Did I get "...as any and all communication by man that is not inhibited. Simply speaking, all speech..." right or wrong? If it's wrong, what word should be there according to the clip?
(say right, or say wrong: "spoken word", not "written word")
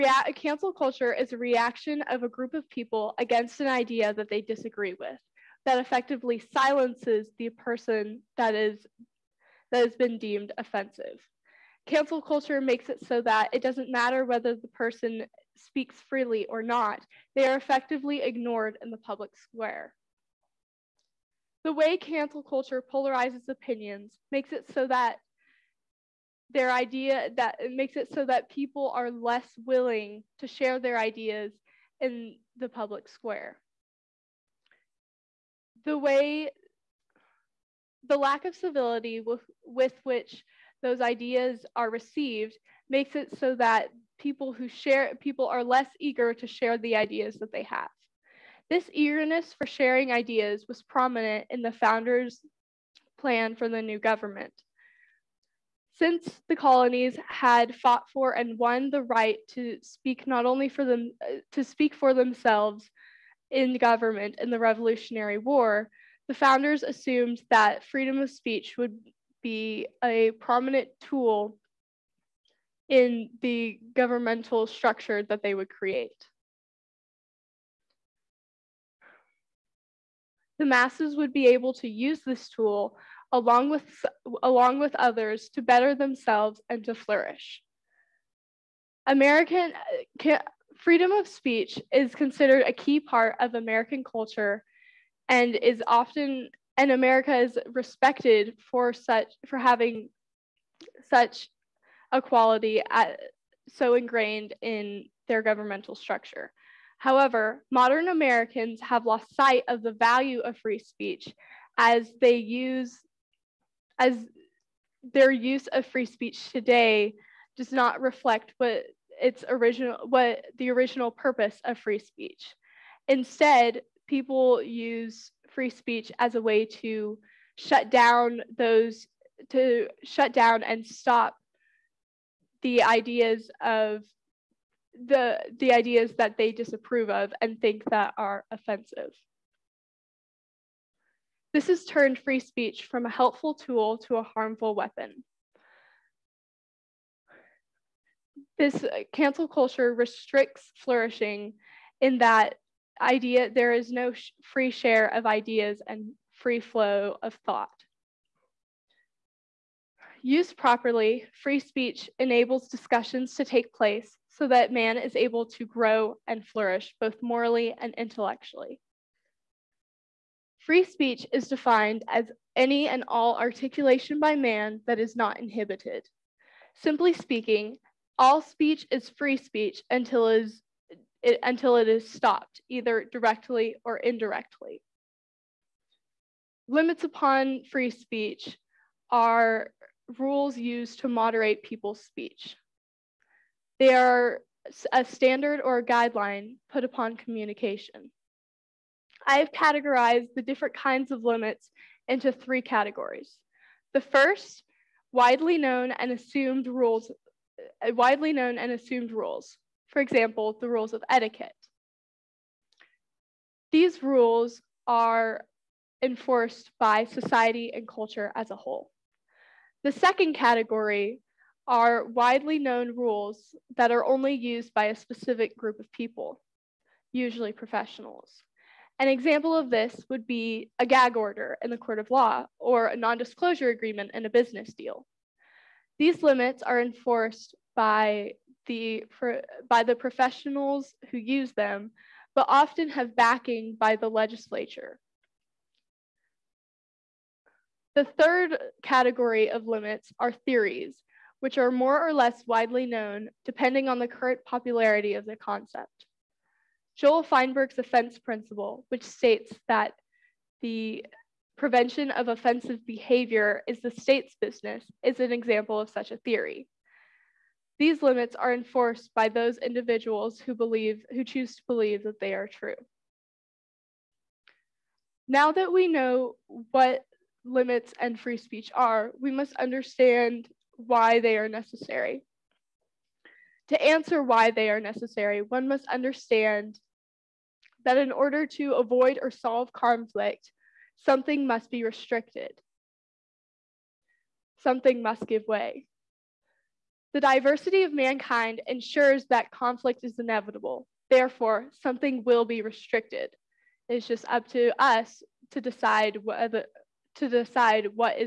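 wrong: "articulation", not "communication".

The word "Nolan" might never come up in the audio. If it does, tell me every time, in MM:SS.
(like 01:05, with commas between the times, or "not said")
not said.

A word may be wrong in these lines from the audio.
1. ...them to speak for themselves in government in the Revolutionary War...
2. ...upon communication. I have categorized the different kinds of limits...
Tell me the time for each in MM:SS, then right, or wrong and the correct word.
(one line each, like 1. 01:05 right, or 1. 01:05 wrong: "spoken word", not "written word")
1. 01:00 right
2. 03:16 right.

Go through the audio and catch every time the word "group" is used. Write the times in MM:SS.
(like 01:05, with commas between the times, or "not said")
00:02, 03:45.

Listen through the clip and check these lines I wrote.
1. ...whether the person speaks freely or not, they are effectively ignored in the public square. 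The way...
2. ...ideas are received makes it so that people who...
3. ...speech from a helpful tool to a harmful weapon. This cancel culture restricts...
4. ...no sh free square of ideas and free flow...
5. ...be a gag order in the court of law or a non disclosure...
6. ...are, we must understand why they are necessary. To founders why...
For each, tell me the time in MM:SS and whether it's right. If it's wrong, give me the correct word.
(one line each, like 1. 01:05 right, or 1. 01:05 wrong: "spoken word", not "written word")
1. 00:14 right
2. 00:41 right
3. 02:22 right
4. 02:33 wrong: "share", not "square"
5. 03:50 right
6. 04:38 wrong: "answer", not "founders".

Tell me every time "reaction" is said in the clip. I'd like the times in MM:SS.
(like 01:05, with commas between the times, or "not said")
00:01.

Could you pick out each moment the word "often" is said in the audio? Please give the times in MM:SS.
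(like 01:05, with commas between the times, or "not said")
01:35, 04:02.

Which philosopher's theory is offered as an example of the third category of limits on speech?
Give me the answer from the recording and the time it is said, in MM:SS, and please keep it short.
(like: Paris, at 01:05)
Joel Feinberg, at 04:16.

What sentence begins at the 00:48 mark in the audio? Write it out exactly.
This eagerness for sharing ideas was prominent in the founders' plan for the new government.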